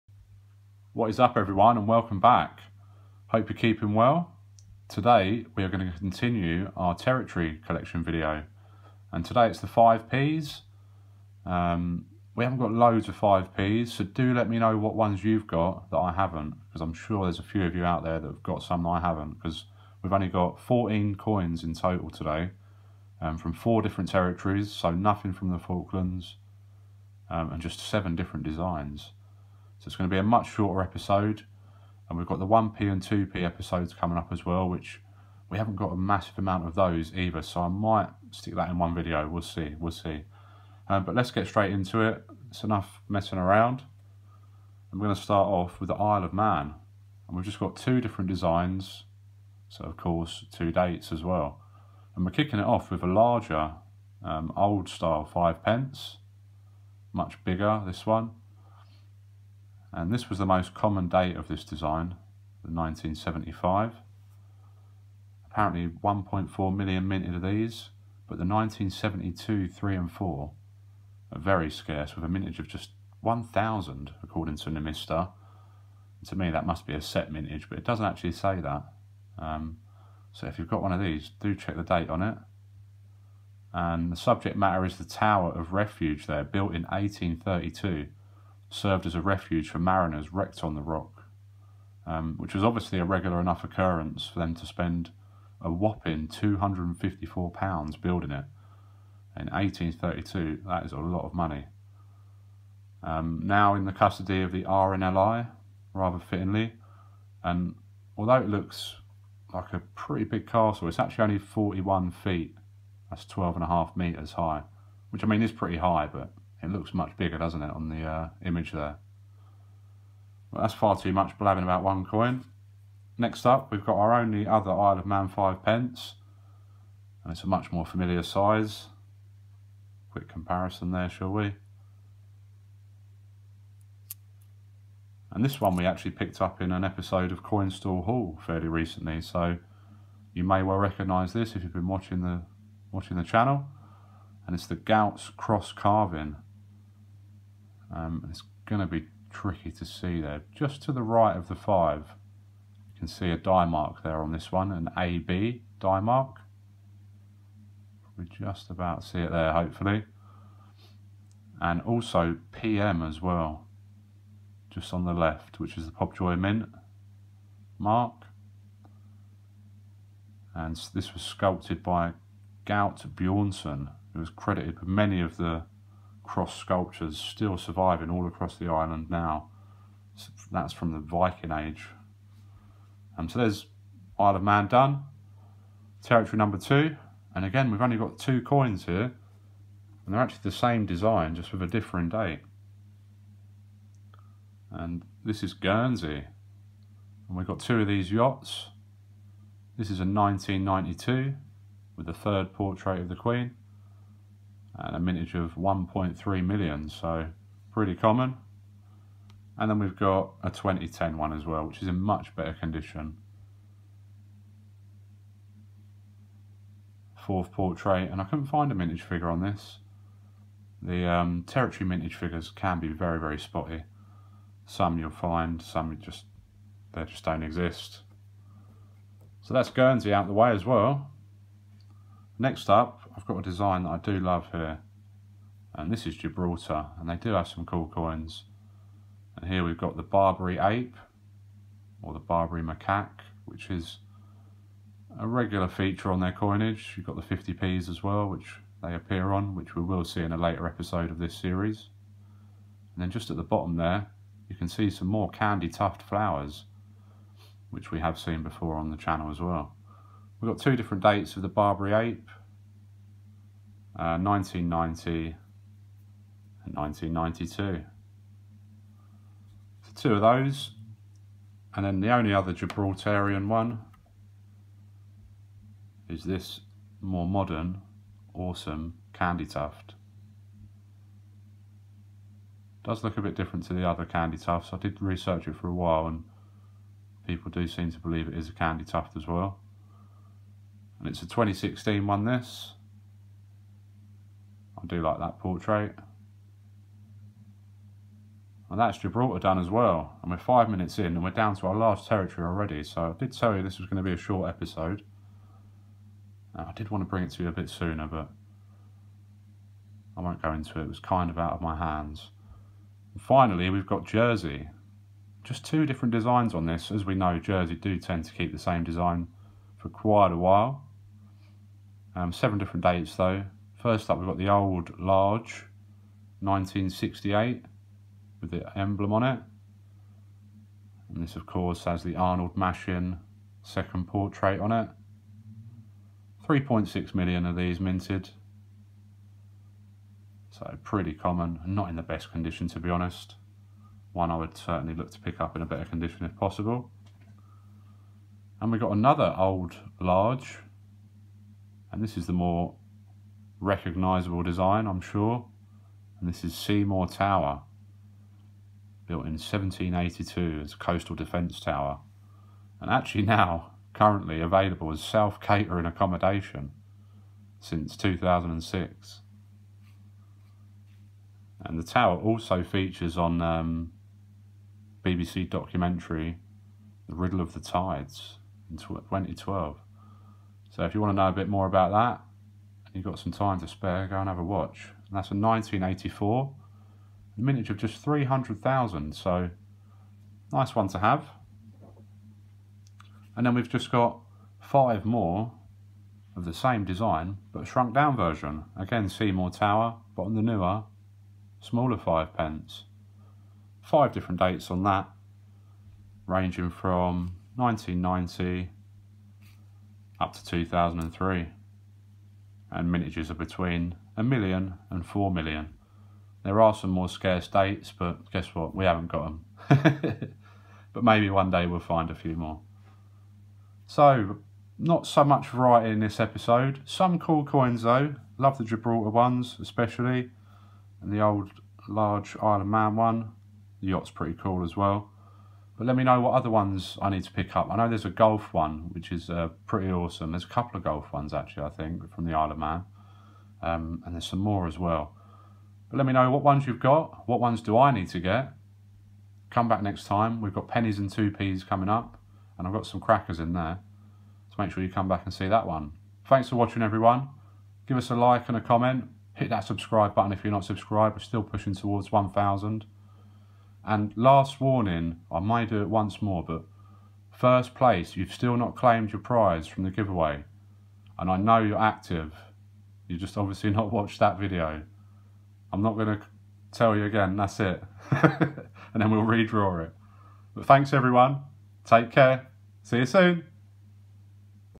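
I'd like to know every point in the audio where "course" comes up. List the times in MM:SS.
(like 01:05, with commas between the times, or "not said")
00:49, 05:31.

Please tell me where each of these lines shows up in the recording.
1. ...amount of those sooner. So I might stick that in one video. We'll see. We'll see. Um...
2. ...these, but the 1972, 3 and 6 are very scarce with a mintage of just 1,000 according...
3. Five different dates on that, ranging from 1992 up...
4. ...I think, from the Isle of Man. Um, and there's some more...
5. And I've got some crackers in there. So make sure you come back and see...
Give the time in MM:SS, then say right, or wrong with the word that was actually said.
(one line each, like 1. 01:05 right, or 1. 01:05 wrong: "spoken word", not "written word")
1. 00:36 wrong: "either", not "sooner"
2. 01:07 wrong: "4", not "6"
3. 06:43 wrong: "1990", not "1992"
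4. 07:21 right
5. 07:32 right.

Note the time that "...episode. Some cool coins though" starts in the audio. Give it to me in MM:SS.
07:06.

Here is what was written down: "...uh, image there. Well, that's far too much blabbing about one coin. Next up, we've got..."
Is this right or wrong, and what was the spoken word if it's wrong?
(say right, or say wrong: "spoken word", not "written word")
right.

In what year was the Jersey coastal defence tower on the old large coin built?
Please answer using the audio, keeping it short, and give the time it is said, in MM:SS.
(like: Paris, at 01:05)
1782, at 05:59.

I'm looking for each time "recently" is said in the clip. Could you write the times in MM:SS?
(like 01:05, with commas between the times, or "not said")
02:18.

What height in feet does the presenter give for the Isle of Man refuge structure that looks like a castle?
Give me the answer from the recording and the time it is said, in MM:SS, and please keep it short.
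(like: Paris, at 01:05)
41 feet, at 01:51.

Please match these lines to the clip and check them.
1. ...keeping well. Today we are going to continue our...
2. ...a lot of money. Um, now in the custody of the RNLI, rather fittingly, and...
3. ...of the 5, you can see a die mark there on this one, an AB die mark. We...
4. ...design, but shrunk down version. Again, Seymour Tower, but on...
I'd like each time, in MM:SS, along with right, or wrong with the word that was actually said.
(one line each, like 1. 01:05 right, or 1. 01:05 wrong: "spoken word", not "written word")
1. 00:03 right
2. 01:40 right
3. 02:31 right
4. 06:36 right.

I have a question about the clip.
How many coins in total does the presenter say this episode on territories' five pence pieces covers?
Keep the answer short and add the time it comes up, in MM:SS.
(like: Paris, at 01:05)
14, at 00:20.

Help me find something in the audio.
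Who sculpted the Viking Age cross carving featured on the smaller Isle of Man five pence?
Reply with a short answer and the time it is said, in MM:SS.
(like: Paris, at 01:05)
Gaut Bjornsson, at 02:52.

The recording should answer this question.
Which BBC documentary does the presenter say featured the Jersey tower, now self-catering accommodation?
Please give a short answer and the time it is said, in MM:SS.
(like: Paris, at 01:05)
The Riddle of the Tides, at 06:17.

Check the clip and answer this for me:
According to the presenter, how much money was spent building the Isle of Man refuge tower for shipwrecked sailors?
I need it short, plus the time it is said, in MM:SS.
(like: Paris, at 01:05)
£254, at 01:36.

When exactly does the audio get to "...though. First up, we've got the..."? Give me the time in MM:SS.
05:23.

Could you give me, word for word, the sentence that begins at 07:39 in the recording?
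Hit that subscribe button if you're not subscribed.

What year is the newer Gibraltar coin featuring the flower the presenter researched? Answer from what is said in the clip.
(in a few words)
2016.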